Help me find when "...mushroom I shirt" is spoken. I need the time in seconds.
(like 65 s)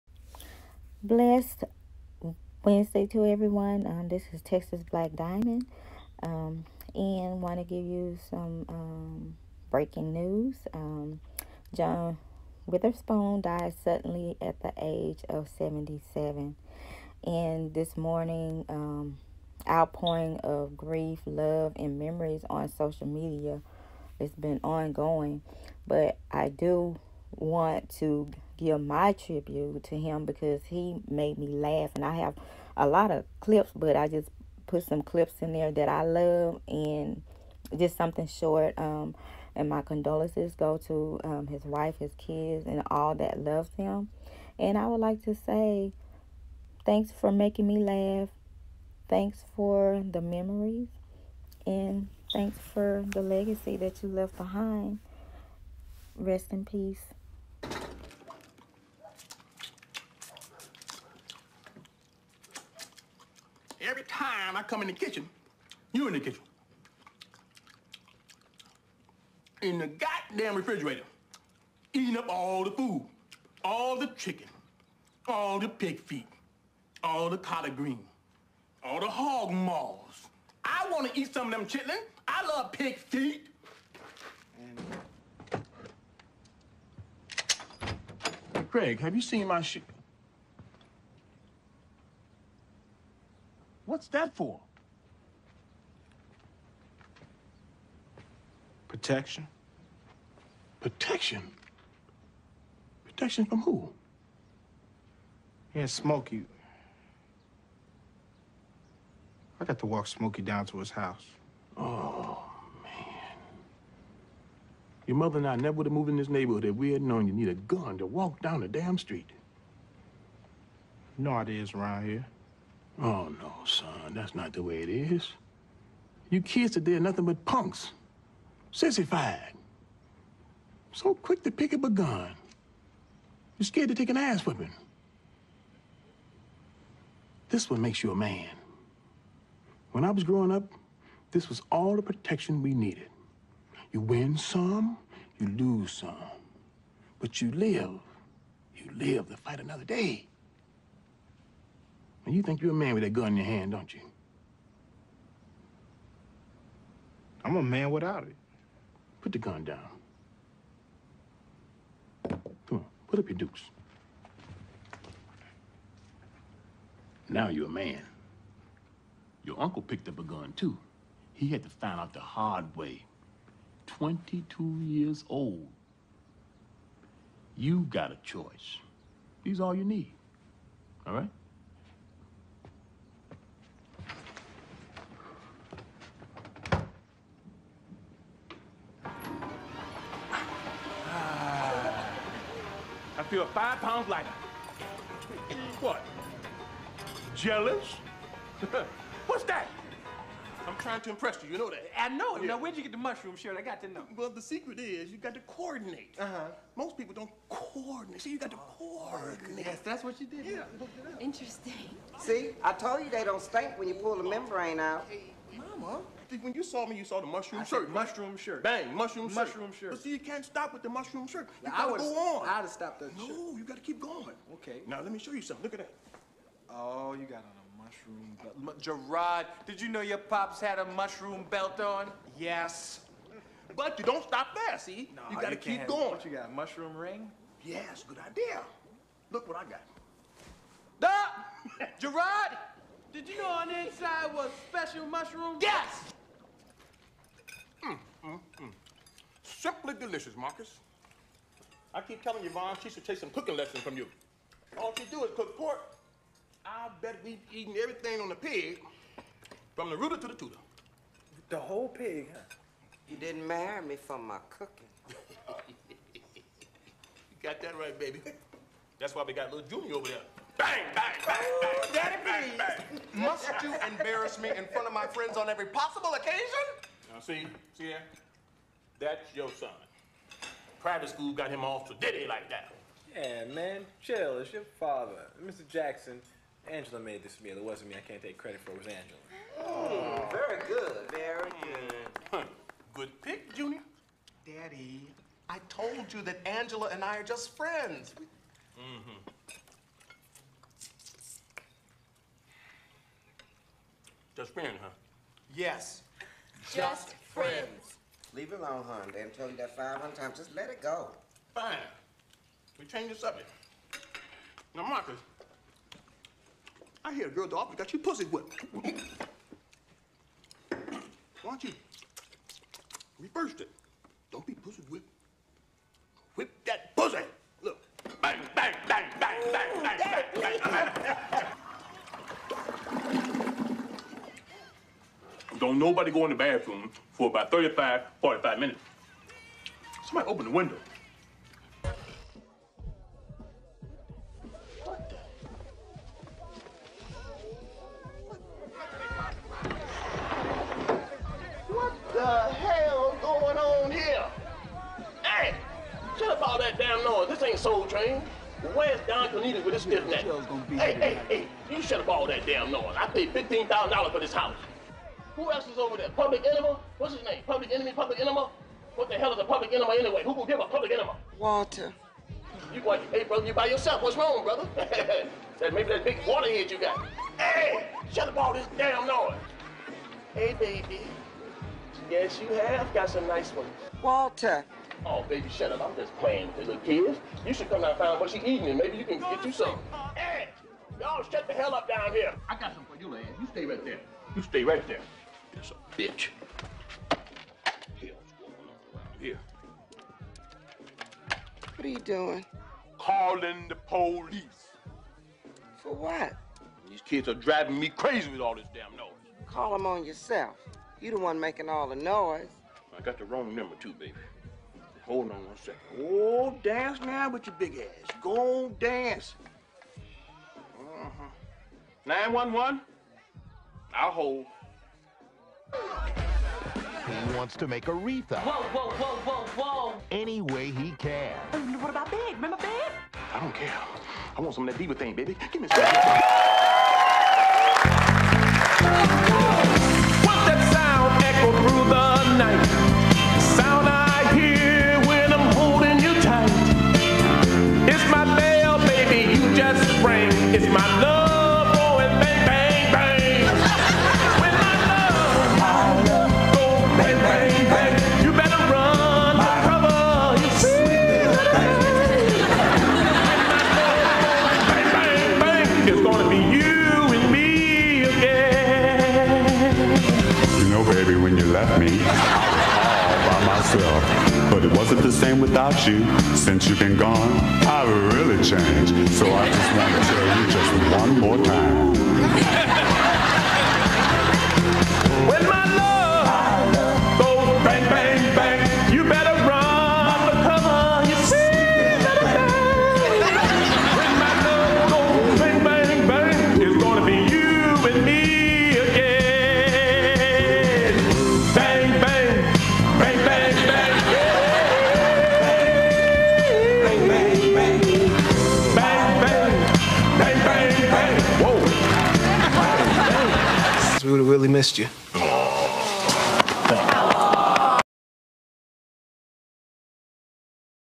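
217 s.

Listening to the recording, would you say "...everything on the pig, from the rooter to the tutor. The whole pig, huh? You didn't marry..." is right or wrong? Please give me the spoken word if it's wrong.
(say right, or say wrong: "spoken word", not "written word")
right.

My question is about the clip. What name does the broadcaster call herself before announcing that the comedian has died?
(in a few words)
Texas Black Diamond.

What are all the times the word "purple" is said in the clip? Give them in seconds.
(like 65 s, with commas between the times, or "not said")
not said.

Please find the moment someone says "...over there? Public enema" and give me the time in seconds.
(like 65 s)
365 s.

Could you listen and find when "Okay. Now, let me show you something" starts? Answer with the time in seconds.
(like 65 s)
224 s.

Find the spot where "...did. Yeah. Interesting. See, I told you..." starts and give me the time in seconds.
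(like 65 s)
210 s.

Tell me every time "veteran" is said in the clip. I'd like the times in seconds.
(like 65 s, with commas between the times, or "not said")
not said.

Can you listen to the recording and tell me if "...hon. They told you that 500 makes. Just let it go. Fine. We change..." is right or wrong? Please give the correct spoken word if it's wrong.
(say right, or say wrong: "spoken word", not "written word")
wrong: "times", not "makes".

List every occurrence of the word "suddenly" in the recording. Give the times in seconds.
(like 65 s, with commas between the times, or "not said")
13 s.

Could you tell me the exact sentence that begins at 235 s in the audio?
No, you gotta you keep going.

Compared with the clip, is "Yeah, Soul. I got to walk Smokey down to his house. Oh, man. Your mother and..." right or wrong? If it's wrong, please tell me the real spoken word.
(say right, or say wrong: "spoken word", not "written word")
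wrong: "Smokey", not "Soul".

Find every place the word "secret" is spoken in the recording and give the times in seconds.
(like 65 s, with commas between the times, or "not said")
204 s.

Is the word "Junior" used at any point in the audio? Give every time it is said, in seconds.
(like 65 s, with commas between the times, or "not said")
269 s, 293 s.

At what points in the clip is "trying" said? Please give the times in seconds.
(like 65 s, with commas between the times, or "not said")
200 s.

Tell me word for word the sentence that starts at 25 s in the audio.
But I do want to give my tribute to him because he made me laugh.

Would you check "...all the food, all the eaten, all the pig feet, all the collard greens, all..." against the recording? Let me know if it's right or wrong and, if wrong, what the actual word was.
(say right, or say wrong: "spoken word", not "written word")
wrong: "chicken", not "eaten".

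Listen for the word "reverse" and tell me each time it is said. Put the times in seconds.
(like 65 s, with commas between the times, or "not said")
323 s.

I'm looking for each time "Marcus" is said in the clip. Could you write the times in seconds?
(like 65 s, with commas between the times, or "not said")
250 s, 314 s.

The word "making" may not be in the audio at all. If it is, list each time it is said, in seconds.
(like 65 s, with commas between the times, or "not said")
47 s, 411 s.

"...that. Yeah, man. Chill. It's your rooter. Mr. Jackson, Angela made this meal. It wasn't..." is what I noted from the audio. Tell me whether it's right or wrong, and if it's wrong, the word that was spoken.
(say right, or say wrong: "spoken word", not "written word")
wrong: "father", not "rooter".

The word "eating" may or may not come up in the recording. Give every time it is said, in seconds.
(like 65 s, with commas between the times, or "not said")
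71 s, 388 s.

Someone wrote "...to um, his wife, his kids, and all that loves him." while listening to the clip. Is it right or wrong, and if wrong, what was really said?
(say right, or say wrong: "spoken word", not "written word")
right.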